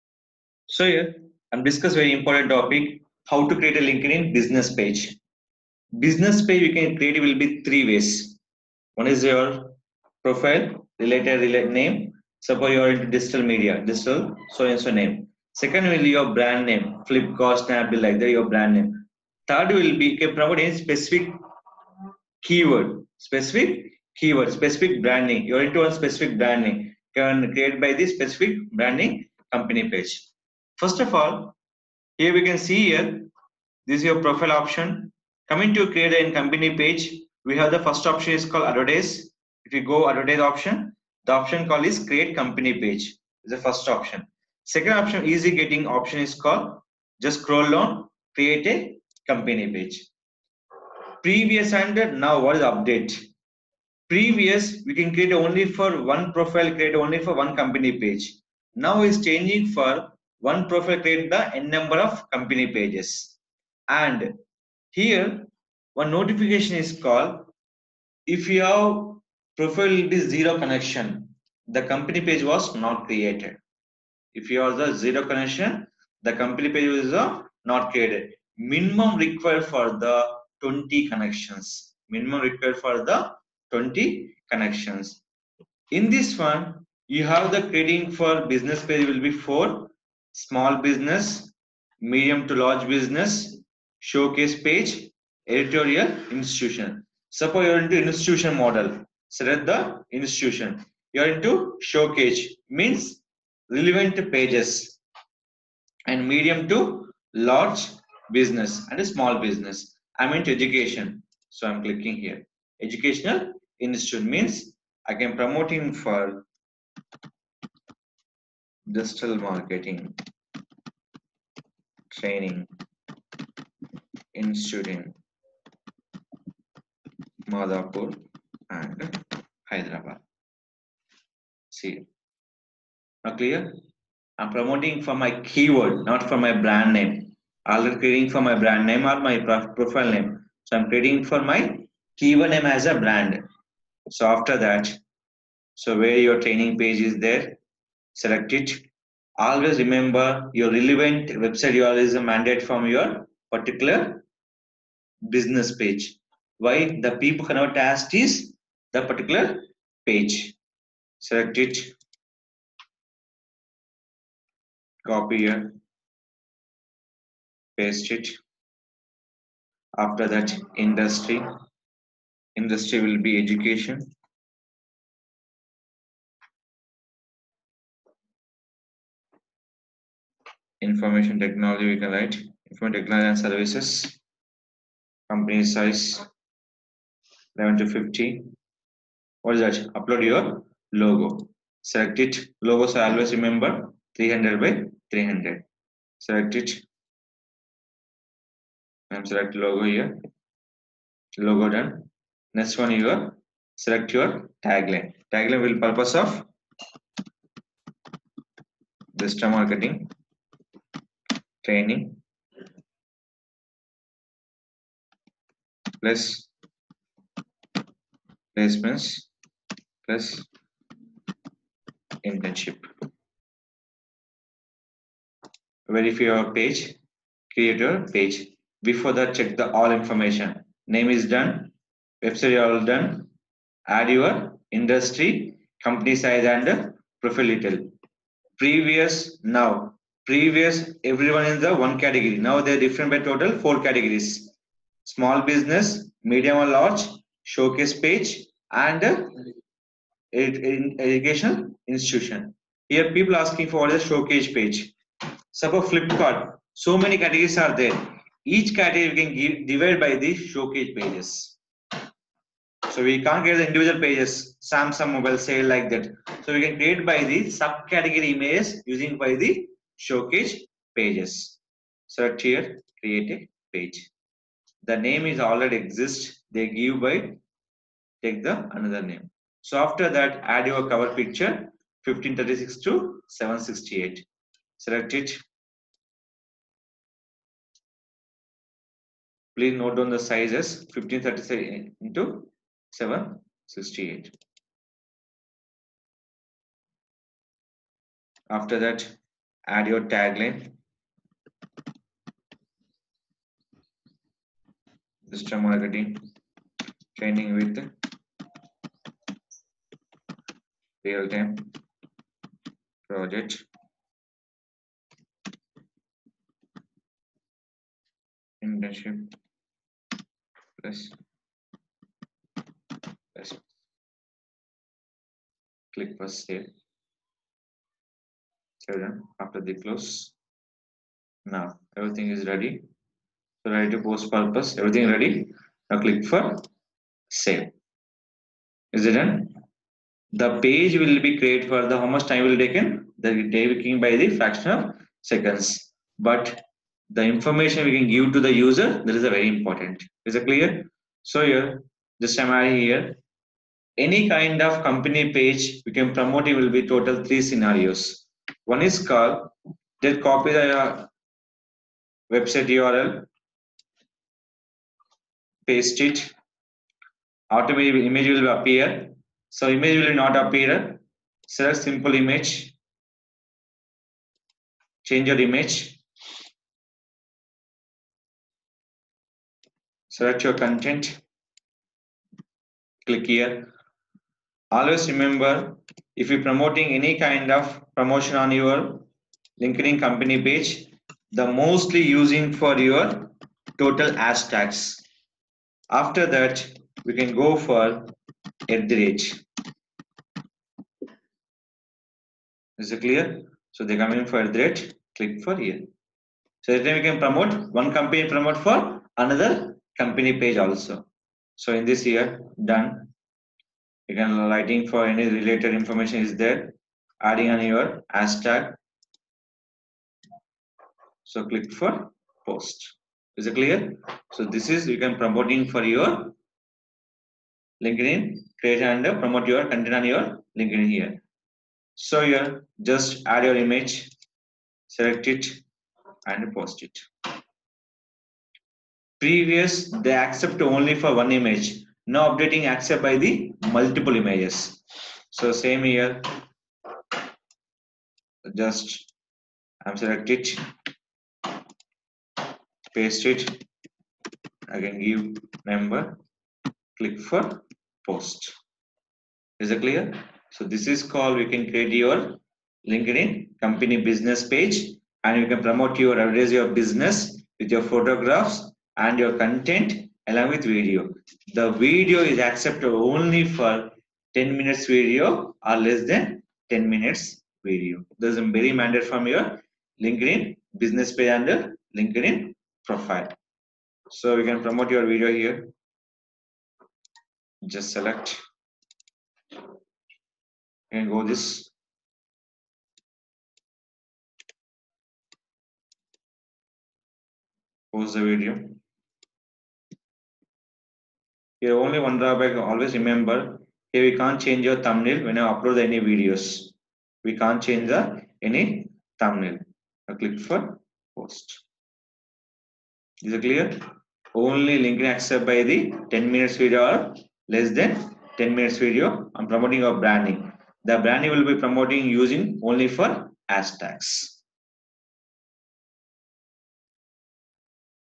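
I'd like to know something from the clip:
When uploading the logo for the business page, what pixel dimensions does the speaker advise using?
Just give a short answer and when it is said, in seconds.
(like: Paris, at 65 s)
300 by 300, at 193 s.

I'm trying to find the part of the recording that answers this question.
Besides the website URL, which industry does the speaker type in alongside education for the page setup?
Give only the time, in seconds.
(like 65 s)
182 s.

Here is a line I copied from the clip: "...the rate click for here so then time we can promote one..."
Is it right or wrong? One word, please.
right.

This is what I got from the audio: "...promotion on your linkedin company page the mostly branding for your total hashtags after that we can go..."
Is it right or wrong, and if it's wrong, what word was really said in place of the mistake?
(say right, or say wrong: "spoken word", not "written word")
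wrong: "using", not "branding".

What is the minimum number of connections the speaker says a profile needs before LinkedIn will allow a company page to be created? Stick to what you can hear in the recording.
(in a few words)
20.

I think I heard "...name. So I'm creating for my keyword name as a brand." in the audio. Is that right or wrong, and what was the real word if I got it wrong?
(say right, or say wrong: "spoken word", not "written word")
right.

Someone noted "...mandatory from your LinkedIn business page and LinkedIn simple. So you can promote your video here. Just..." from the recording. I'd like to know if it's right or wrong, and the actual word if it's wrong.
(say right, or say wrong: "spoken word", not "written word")
wrong: "profile", not "simple".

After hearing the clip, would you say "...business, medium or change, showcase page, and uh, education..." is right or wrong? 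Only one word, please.
wrong.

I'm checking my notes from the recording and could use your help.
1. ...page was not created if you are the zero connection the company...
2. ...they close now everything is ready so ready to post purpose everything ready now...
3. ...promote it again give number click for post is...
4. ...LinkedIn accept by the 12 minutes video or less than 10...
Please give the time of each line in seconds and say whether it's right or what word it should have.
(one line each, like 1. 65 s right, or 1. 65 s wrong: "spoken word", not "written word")
1. 72 s right
2. 329 s right
3. 452 s wrong: "paste", not "promote"
4. 514 s wrong: "10", not "12".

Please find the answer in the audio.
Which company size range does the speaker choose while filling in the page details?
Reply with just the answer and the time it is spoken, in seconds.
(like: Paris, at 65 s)
11 to 50, at 187 s.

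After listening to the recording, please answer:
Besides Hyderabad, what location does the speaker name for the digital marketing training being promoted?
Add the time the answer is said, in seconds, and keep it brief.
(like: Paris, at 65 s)
Madhapur, at 127 s.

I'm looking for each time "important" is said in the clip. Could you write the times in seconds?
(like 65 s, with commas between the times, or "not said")
2 s, 349 s.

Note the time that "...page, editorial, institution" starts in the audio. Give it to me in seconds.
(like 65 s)
94 s.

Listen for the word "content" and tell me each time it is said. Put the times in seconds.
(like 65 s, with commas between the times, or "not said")
380 s, 429 s, 469 s.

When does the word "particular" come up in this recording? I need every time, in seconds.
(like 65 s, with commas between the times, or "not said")
153 s, 159 s.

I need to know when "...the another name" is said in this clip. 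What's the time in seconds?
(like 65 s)
278 s.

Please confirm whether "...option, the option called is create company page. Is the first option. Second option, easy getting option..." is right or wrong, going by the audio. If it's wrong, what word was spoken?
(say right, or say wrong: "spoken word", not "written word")
right.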